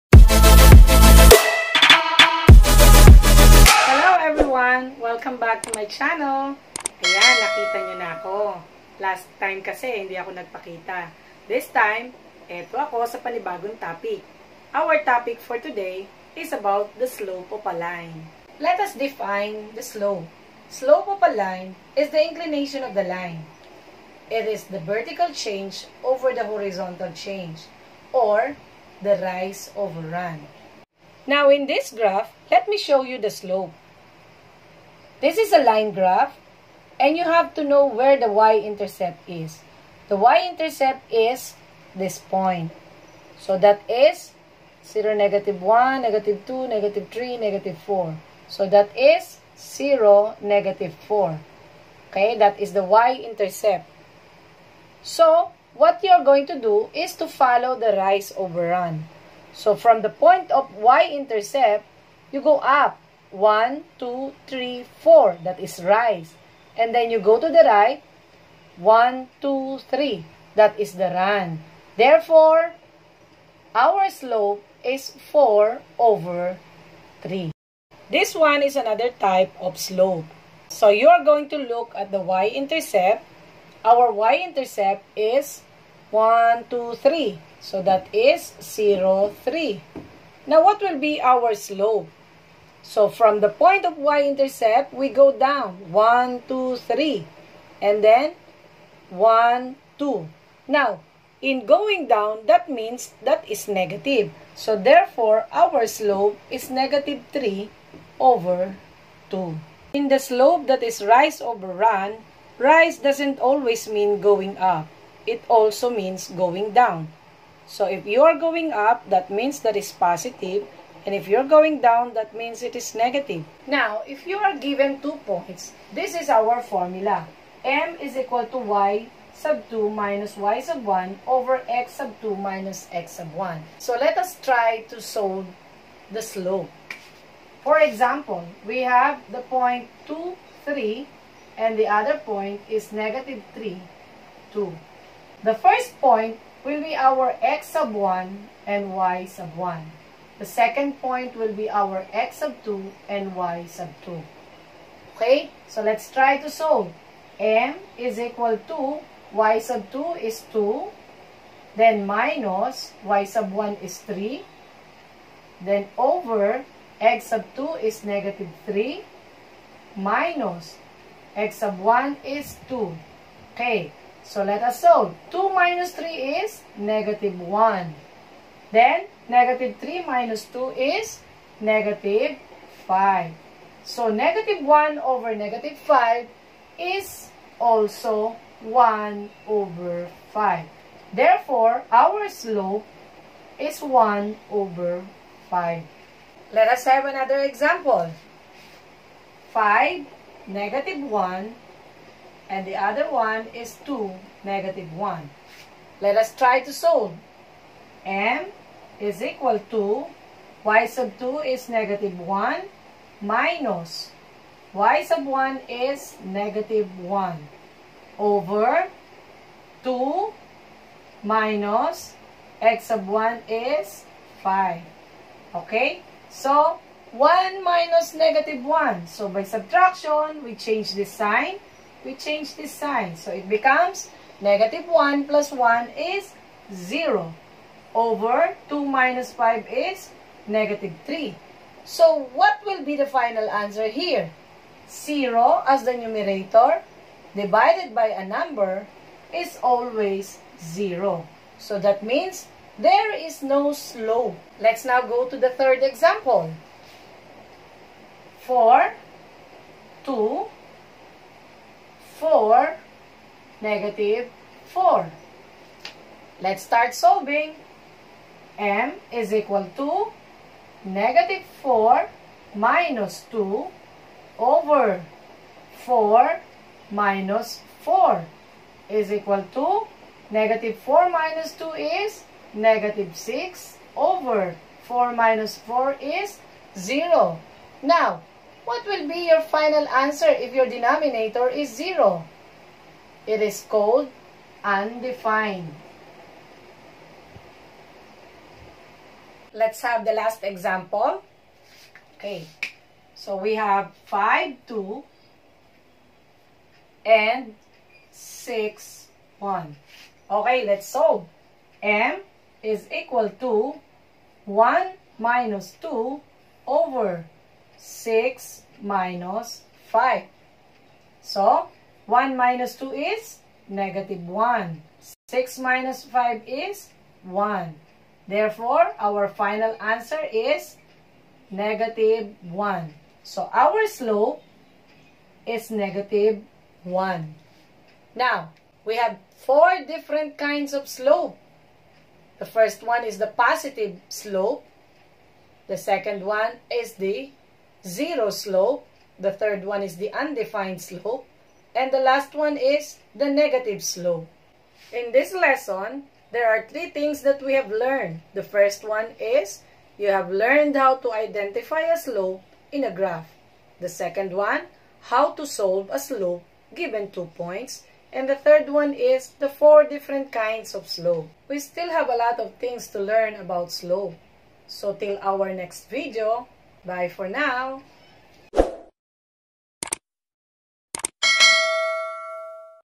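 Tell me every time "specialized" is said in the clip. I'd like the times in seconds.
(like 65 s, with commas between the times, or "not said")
not said.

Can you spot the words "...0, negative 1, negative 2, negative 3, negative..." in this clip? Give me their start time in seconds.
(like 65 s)
44 s.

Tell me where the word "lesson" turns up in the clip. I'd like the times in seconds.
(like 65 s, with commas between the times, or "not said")
355 s.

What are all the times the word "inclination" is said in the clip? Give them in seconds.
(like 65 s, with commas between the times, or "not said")
22 s.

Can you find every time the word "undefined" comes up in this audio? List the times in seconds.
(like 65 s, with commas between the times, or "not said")
294 s, 350 s.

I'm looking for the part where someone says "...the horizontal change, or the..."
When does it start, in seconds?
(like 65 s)
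26 s.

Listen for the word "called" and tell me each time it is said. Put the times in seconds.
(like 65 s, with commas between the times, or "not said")
293 s.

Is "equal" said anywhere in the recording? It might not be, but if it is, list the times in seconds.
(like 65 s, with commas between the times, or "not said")
128 s, 158 s, 209 s, 269 s, 279 s, 312 s.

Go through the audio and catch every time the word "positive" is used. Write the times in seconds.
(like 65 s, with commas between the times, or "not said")
119 s, 343 s.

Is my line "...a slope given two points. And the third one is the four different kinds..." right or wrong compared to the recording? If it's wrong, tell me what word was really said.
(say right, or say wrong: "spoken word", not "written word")
right.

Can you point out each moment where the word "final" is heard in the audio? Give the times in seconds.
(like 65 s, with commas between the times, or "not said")
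243 s, 289 s, 329 s.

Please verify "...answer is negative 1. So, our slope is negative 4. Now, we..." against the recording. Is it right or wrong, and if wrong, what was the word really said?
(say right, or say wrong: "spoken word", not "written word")
wrong: "1", not "4".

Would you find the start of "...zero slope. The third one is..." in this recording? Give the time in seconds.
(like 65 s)
347 s.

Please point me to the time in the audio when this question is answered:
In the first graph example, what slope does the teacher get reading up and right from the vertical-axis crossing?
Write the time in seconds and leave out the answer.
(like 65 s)
75 s.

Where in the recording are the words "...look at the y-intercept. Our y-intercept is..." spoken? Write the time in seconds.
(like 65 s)
81 s.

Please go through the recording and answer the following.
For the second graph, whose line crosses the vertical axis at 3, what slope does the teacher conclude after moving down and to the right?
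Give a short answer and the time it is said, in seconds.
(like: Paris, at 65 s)
-3/2, at 106 s.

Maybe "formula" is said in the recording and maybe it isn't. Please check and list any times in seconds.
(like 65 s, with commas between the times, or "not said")
126 s.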